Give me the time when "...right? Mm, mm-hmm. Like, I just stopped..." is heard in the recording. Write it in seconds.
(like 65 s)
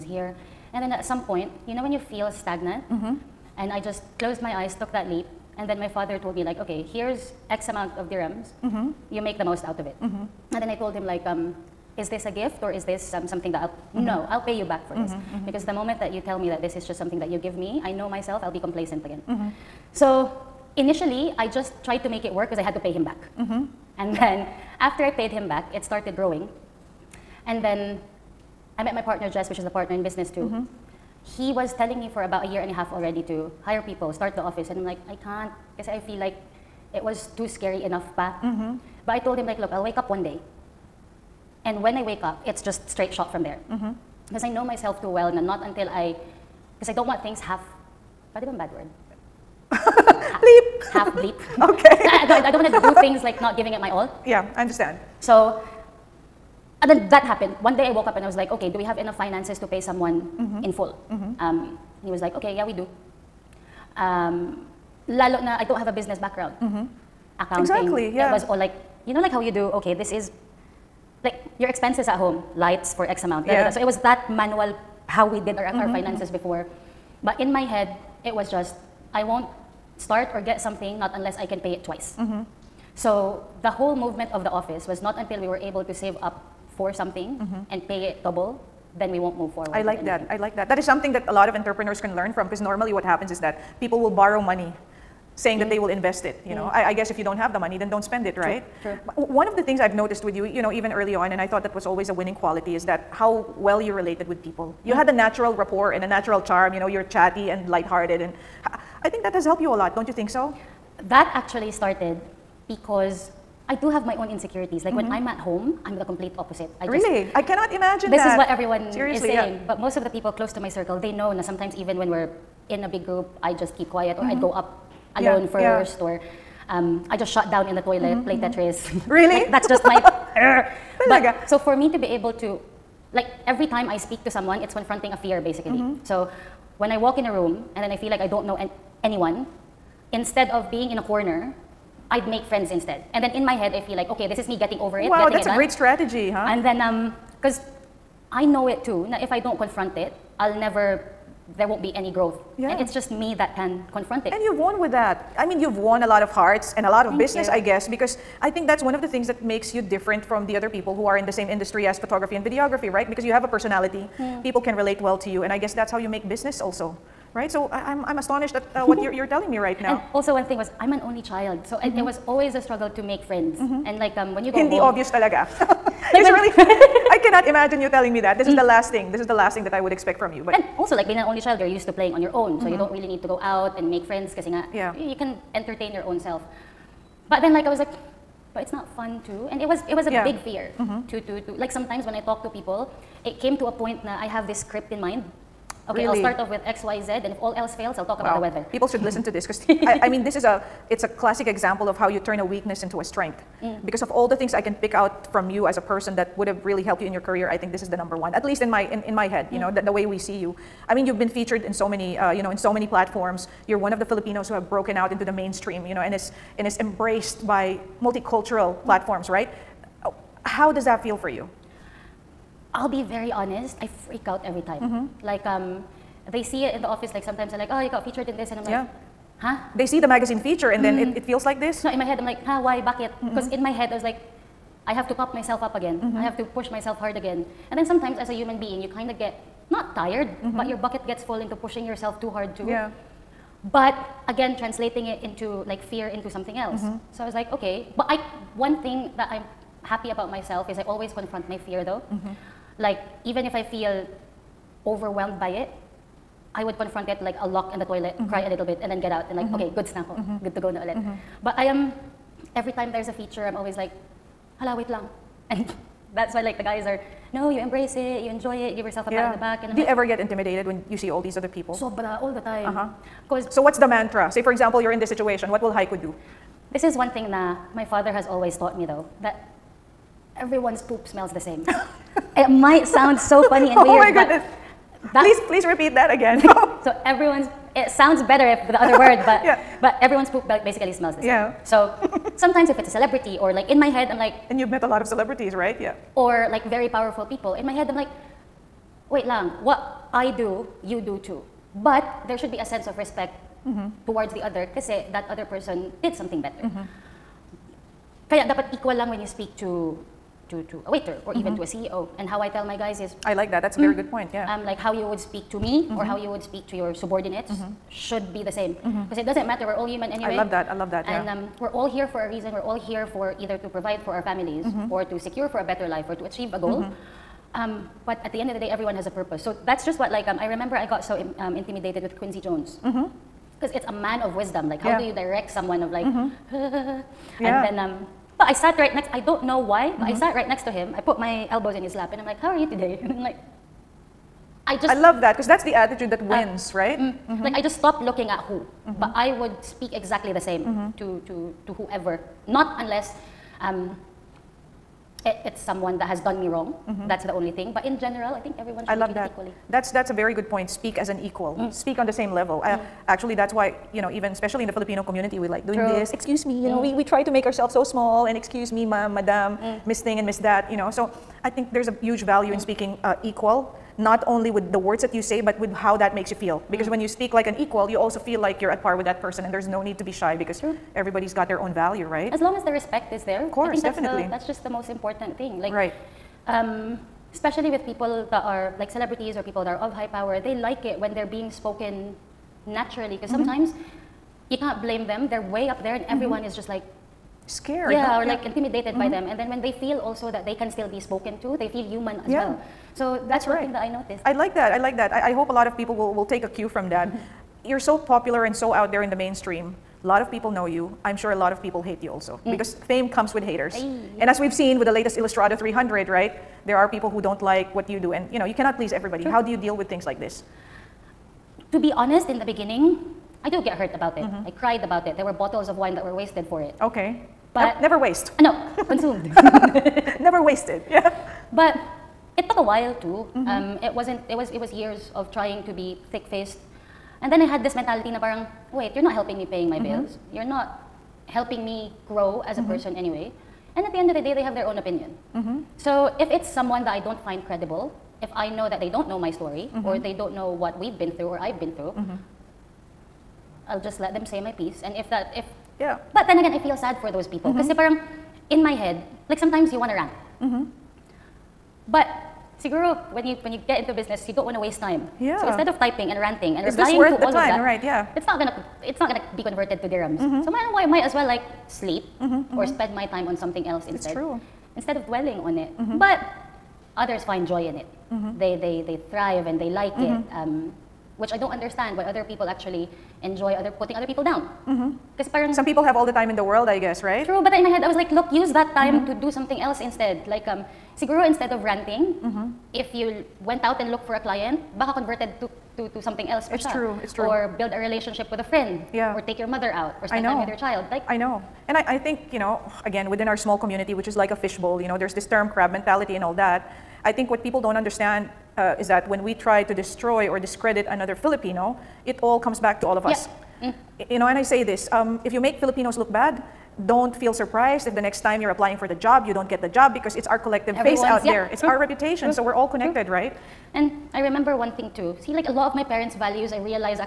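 346 s.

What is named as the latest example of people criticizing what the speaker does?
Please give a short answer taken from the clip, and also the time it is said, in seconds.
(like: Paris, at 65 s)
Illustrado 300, at 415 s.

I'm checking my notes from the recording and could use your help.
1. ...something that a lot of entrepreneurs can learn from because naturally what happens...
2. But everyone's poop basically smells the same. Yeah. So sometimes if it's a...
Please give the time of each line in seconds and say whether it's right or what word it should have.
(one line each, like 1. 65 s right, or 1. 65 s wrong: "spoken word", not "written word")
1. 90 s wrong: "normally", not "naturally"
2. 289 s right.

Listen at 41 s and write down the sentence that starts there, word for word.
And when I wake up, it's just straight shot from there.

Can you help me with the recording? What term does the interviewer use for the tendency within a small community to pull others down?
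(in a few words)
Crab mentality.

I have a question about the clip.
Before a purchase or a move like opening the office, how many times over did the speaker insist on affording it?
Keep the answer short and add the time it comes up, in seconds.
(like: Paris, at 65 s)
Twice, at 81 s.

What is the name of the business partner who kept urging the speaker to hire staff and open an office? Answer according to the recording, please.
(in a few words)
Jess.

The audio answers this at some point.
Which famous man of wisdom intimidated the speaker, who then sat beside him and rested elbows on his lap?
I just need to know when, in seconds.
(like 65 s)
332 s.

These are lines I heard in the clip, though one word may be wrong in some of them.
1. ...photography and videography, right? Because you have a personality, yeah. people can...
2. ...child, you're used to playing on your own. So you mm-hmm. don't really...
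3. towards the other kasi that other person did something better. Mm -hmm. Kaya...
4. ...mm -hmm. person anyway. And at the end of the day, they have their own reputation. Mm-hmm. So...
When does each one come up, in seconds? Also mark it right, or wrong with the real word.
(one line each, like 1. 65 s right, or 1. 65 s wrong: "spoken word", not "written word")
1. 161 s right
2. 181 s right
3. 304 s right
4. 442 s wrong: "opinion", not "reputation".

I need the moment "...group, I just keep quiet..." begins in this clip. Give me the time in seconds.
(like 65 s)
123 s.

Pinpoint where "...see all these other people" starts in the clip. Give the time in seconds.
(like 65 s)
270 s.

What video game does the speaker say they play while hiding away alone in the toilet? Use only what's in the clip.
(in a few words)
Tetris.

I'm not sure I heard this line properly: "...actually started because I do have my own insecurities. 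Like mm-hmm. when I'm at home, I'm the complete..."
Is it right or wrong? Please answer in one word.
right.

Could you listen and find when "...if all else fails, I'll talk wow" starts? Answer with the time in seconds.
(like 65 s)
197 s.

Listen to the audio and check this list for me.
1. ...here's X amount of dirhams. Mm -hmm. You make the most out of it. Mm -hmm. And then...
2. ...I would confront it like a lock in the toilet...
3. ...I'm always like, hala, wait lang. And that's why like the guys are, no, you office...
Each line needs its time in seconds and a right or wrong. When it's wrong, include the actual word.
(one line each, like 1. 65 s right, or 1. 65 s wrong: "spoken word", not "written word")
1. 6 s right
2. 256 s right
3. 263 s wrong: "embrace", not "office".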